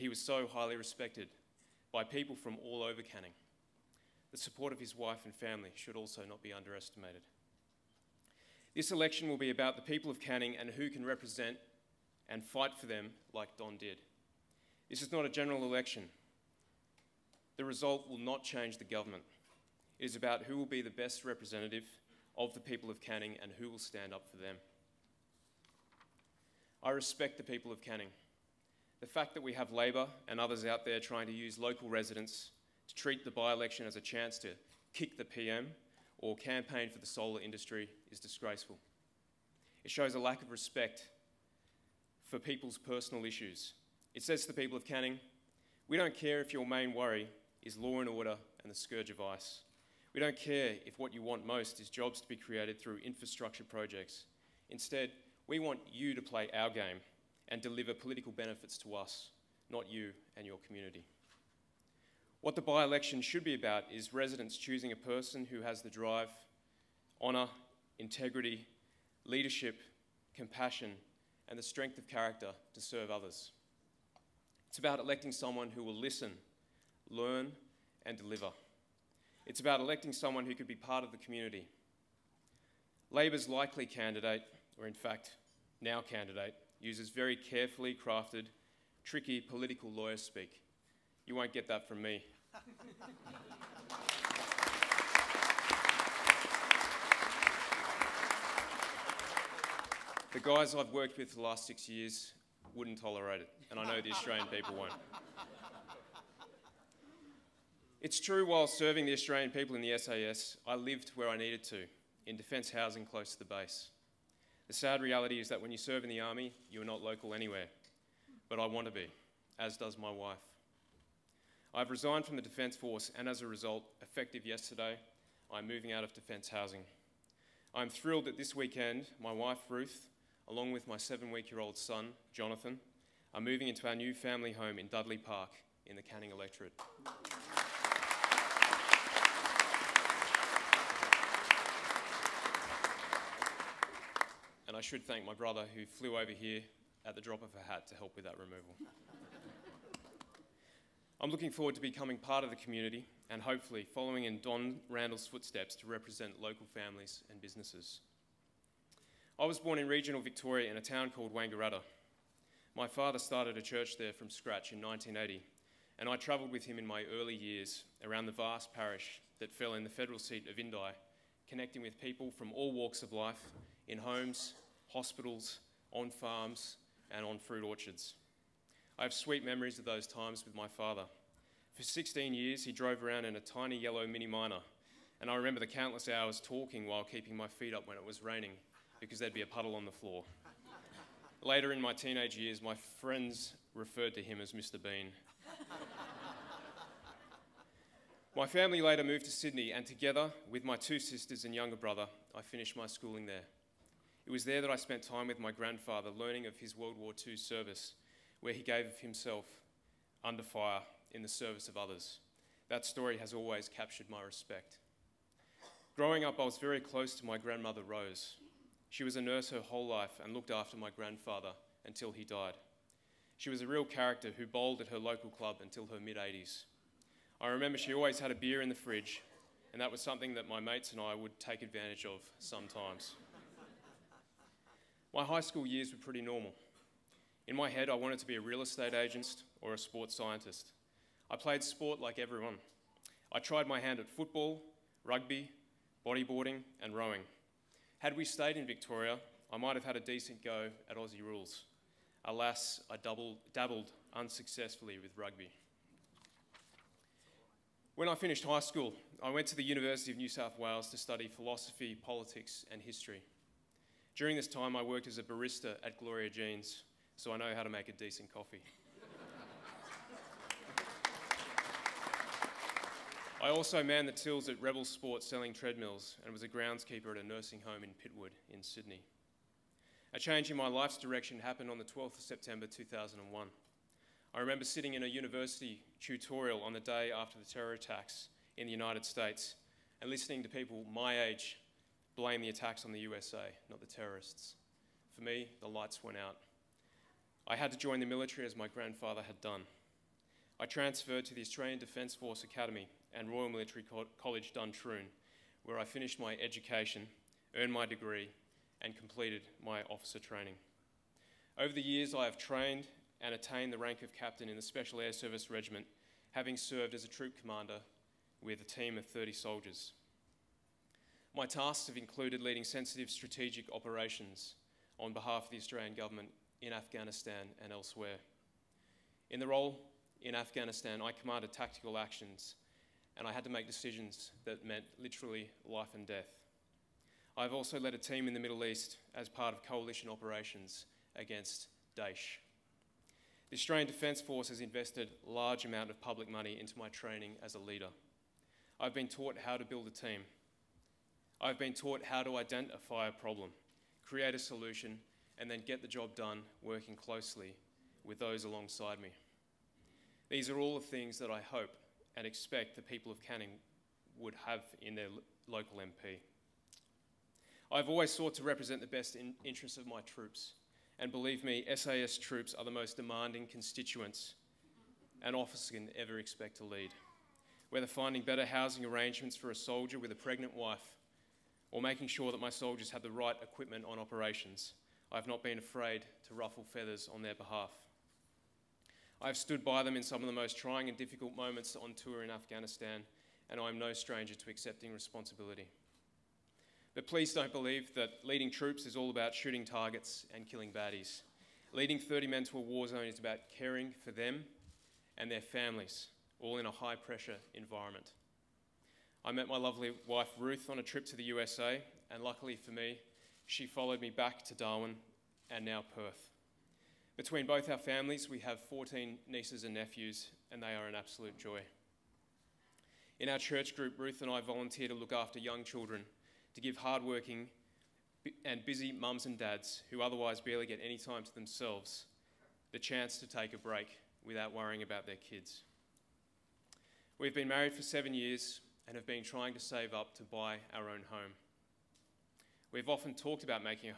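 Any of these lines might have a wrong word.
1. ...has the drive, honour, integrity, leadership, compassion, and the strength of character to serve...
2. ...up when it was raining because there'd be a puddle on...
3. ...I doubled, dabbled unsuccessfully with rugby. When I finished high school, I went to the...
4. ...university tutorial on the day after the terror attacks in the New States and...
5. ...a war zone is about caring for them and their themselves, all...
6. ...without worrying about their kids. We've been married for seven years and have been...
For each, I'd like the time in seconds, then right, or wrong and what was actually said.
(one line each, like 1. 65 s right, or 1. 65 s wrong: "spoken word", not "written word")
1. 65 s right
2. 187 s right
3. 252 s right
4. 285 s wrong: "United", not "New"
5. 402 s wrong: "families", not "themselves"
6. 434 s right.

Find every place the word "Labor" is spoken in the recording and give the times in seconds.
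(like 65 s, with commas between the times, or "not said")
29 s, 83 s.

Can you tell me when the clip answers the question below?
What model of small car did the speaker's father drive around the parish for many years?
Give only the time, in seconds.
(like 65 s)
184 s.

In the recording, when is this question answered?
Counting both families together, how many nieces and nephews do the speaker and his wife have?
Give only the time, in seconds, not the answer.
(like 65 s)
418 s.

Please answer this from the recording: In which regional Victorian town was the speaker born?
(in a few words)
Wangaratta.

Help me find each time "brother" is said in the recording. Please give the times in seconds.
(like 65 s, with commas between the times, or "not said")
145 s, 201 s.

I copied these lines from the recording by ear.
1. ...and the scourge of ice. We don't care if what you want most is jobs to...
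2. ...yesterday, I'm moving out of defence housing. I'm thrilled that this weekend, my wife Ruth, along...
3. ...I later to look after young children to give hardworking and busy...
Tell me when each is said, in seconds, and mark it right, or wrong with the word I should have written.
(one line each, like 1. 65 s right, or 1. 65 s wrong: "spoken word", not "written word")
1. 48 s right
2. 124 s right
3. 424 s wrong: "volunteer", not "later".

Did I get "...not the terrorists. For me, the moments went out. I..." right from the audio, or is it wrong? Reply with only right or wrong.
wrong.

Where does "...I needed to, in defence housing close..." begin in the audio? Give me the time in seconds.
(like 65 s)
111 s.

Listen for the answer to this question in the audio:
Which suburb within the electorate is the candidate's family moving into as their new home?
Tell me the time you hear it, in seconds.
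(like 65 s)
134 s.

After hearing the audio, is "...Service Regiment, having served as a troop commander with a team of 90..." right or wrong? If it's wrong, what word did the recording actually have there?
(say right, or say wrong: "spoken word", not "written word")
wrong: "30", not "90".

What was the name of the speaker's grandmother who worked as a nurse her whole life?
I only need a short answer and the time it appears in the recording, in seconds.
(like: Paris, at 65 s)
Rose, at 217 s.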